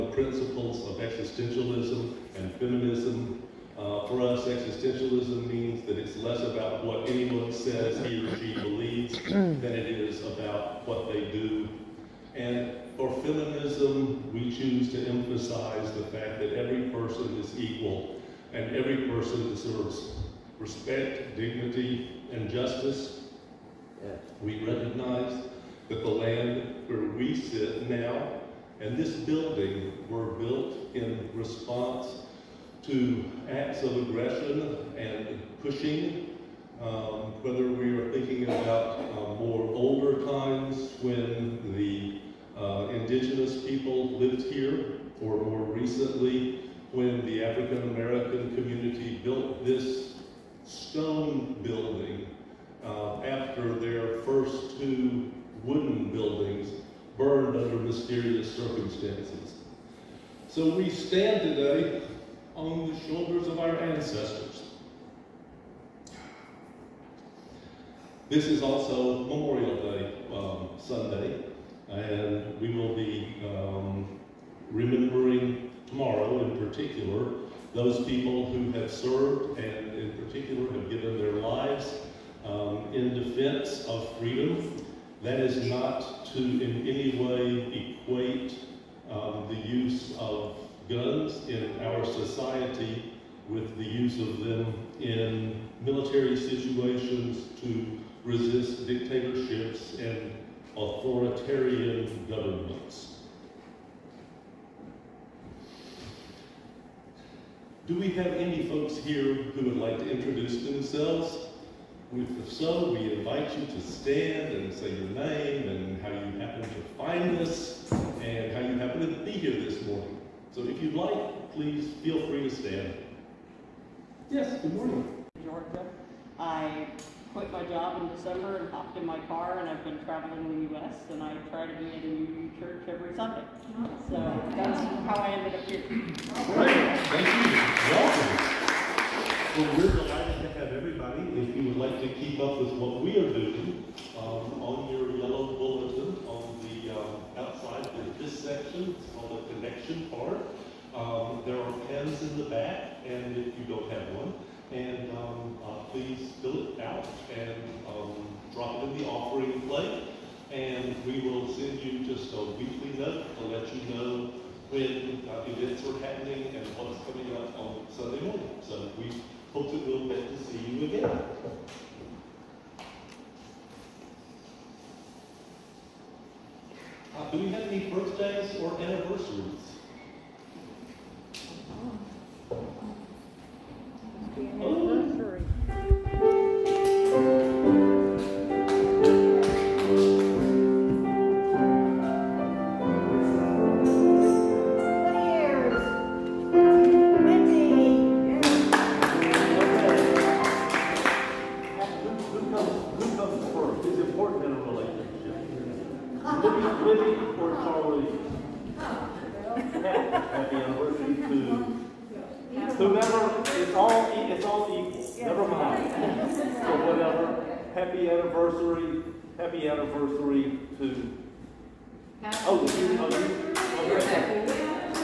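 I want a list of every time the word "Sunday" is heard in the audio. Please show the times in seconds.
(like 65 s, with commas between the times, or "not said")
70 s, 133 s, 167 s.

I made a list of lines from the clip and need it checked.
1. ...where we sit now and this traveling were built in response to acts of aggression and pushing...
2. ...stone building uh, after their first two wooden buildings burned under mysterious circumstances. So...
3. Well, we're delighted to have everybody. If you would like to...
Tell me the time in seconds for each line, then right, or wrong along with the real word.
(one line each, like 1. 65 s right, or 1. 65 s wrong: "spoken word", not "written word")
1. 26 s wrong: "building", not "traveling"
2. 50 s right
3. 139 s right.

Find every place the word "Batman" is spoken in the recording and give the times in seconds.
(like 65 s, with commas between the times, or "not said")
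not said.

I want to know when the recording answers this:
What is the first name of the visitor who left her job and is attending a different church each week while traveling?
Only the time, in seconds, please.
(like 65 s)
125 s.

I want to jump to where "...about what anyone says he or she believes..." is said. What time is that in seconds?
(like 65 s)
6 s.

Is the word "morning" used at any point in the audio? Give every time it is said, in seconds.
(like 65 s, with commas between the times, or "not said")
119 s, 124 s, 168 s.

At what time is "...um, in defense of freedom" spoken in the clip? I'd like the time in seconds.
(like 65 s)
82 s.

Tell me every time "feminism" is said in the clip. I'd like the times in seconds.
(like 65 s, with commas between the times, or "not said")
2 s, 13 s.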